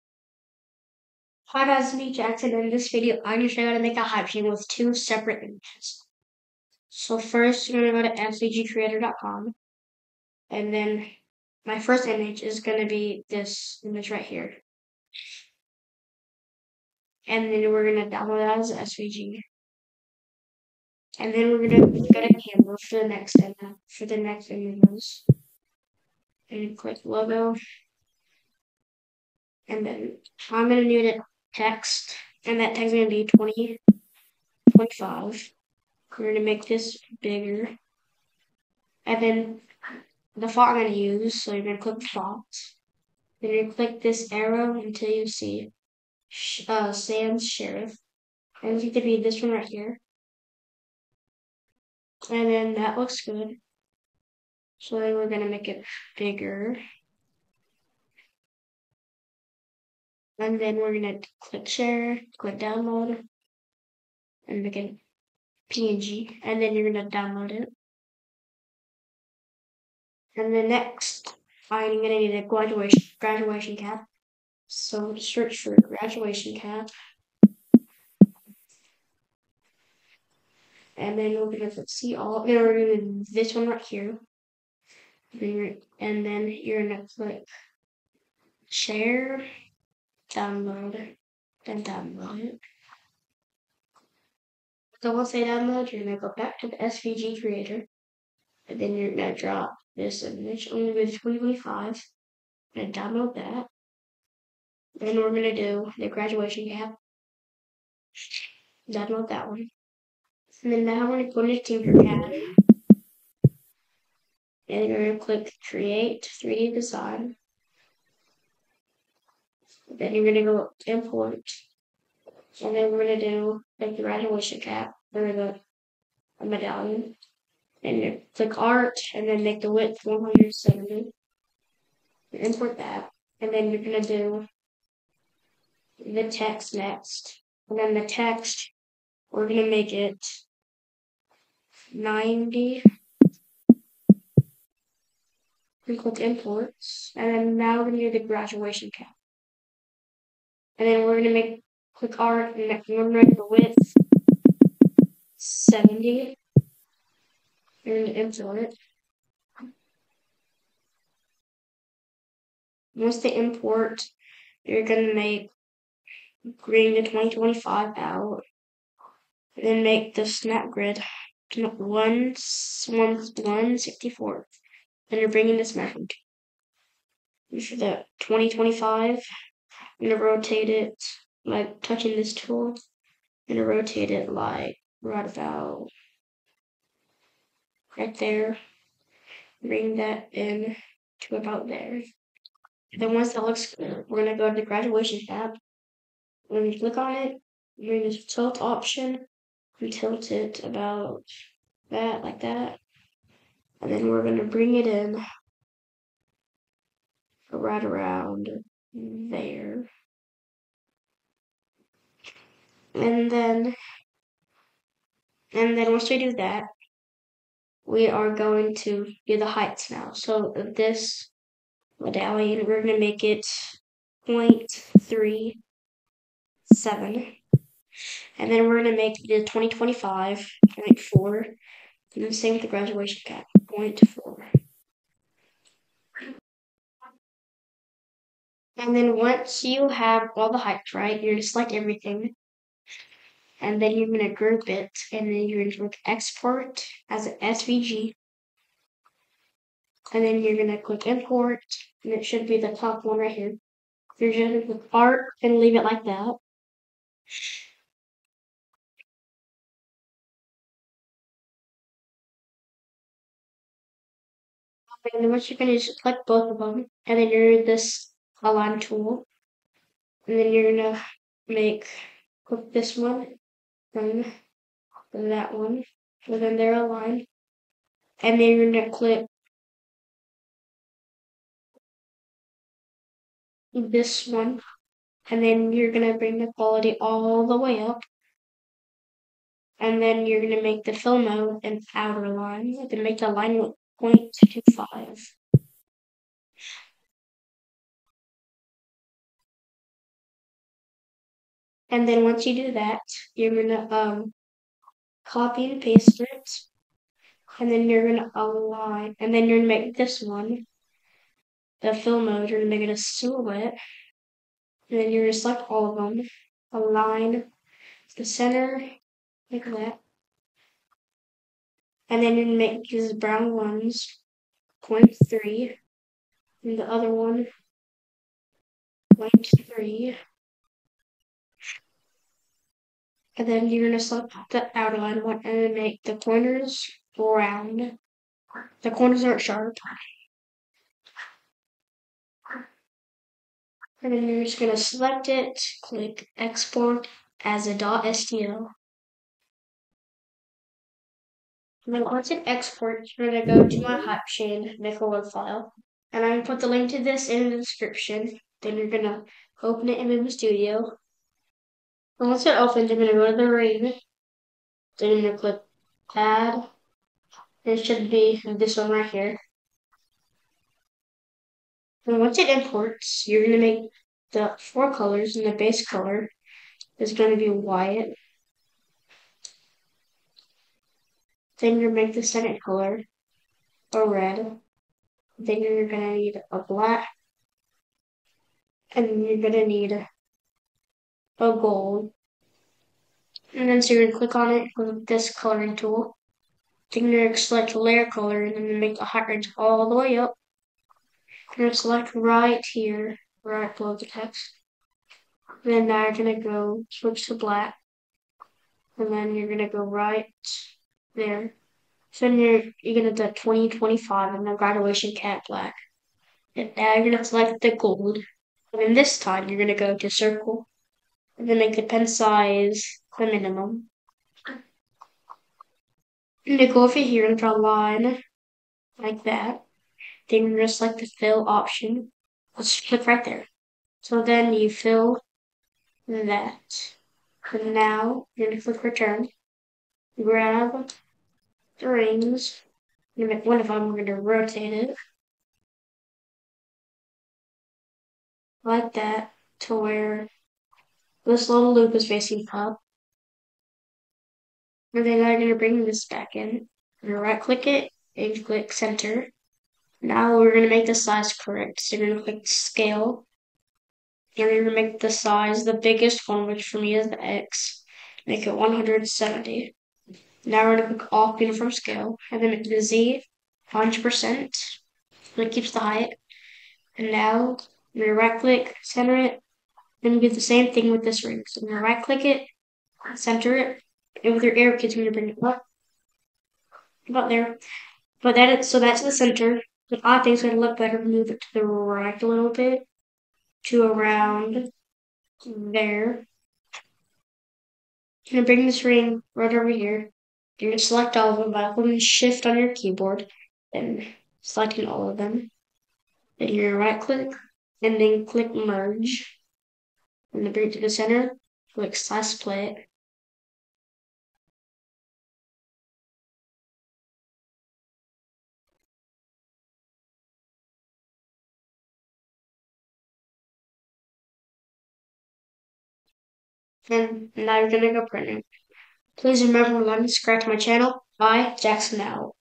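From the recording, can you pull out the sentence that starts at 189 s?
Bring that in to about there.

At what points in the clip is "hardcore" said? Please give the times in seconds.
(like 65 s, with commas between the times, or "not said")
not said.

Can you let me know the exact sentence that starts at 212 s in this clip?
And then, and then once we do that, we are going to do the heights now.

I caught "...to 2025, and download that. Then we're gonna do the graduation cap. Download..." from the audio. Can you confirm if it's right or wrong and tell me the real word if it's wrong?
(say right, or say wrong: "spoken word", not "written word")
right.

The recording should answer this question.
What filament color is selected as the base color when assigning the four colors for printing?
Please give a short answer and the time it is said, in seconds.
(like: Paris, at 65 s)
White, at 377 s.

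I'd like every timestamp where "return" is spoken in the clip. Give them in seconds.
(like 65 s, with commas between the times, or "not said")
438 s.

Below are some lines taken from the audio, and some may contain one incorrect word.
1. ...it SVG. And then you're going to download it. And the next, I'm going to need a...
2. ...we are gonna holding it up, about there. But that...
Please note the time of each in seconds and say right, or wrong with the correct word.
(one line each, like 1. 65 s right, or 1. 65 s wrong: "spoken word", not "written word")
1. 64 s wrong: "PNG", not "SVG"
2. 484 s wrong: "bring", not "holding".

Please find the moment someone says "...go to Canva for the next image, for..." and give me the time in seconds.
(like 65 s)
22 s.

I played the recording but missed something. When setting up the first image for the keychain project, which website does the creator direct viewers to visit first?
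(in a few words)
mcgcreator.com.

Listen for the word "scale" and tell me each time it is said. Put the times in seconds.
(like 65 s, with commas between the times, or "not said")
462 s, 471 s.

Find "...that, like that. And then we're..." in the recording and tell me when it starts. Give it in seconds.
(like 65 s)
201 s.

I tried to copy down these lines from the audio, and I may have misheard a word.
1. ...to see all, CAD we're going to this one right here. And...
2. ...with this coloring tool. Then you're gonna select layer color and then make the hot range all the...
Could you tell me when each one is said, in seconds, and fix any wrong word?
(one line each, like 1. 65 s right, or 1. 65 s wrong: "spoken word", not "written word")
1. 81 s wrong: "And", not "CAD"
2. 394 s right.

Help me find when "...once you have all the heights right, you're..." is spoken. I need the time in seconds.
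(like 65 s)
239 s.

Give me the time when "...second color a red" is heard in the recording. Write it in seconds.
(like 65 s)
382 s.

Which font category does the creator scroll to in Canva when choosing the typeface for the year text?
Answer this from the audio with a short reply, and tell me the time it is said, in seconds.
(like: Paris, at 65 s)
Sans Serif, at 46 s.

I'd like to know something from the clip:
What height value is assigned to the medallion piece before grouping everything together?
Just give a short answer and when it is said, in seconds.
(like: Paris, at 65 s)
0.37, at 224 s.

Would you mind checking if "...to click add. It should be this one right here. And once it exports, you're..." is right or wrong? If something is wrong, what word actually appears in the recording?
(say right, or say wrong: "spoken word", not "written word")
wrong: "imports", not "exports".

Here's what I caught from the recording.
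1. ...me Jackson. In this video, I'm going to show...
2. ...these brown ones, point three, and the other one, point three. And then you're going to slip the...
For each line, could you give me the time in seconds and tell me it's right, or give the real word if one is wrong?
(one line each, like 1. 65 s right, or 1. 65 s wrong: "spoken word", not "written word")
1. 1 s right
2. 322 s right.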